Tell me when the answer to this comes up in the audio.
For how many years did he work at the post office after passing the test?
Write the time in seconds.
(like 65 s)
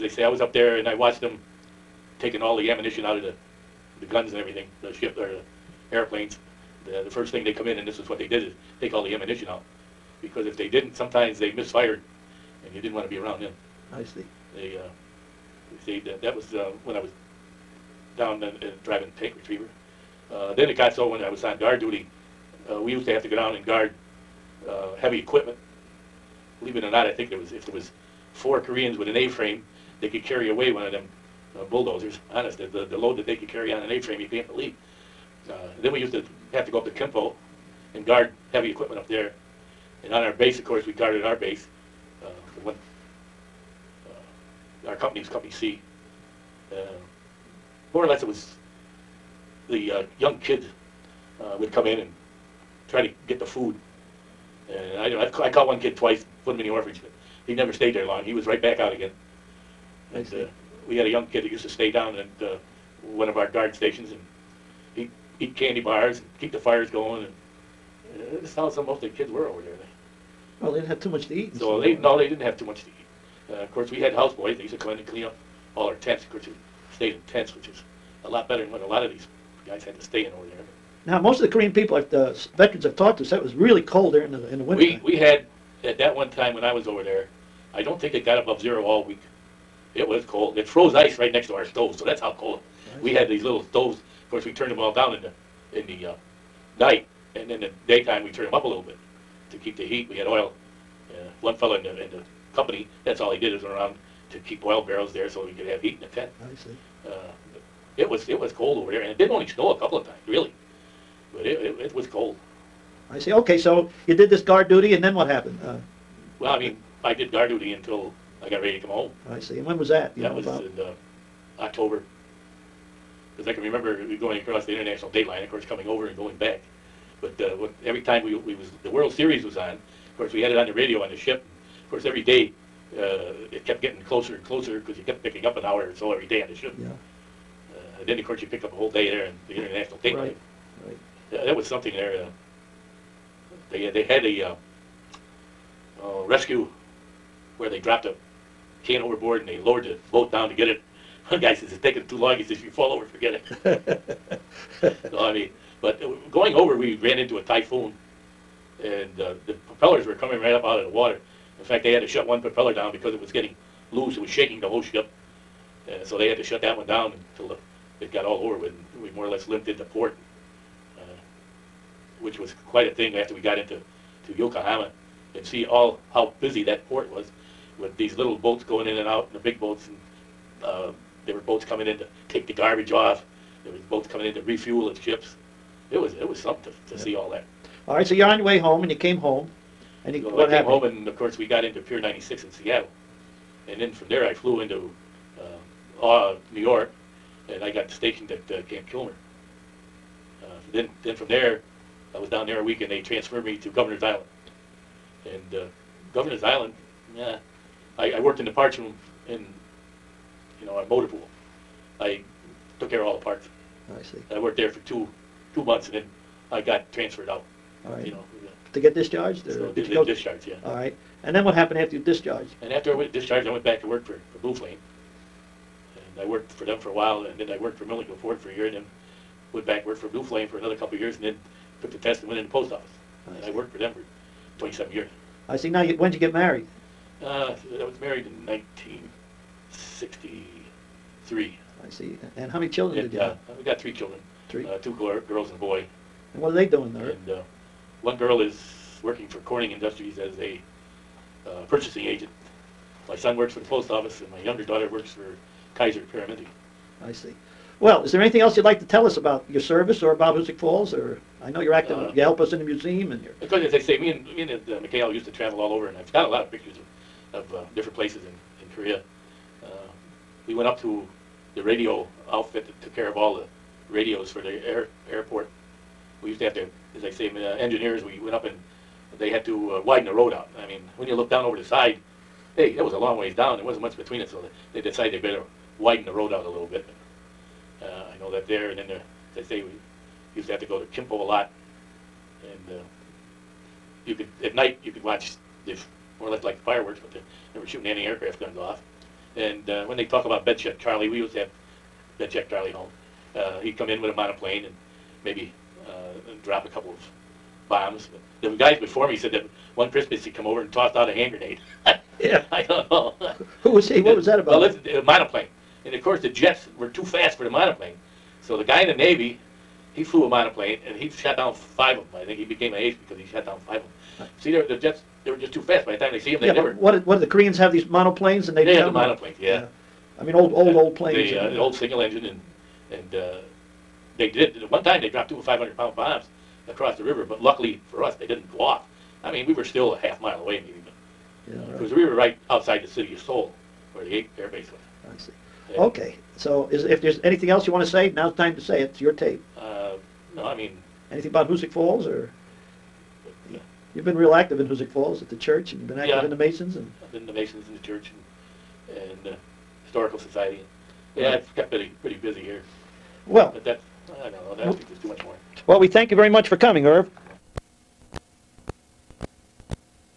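234 s.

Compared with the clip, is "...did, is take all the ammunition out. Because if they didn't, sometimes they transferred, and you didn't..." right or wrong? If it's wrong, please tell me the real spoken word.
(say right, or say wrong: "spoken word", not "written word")
wrong: "misfired", not "transferred".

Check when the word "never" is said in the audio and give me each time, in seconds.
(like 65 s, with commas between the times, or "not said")
57 s, 326 s.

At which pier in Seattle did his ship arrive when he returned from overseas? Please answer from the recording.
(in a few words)
Pier 96.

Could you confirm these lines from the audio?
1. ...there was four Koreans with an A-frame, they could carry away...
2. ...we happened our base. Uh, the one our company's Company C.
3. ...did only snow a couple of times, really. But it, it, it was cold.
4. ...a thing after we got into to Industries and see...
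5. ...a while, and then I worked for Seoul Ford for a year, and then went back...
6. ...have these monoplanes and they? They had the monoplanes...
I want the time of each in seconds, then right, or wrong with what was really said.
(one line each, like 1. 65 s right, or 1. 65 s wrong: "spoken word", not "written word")
1. 27 s right
2. 40 s wrong: "guarded", not "happened"
3. 109 s right
4. 172 s wrong: "Yokohama", not "Industries"
5. 226 s wrong: "Millington", not "Seoul"
6. 327 s right.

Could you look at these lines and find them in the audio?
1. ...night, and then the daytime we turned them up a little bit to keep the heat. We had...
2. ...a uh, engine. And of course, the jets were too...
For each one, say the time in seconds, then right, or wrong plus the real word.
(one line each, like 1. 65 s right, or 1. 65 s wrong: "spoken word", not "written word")
1. 96 s right
2. 314 s wrong: "monoplane", not "engine".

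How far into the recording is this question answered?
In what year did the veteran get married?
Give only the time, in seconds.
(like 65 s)
238 s.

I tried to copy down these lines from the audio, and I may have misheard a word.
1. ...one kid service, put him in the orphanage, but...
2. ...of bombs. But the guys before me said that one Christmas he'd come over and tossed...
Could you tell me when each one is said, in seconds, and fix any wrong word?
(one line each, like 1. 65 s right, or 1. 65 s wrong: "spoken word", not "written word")
1. 55 s wrong: "twice", not "service"
2. 306 s right.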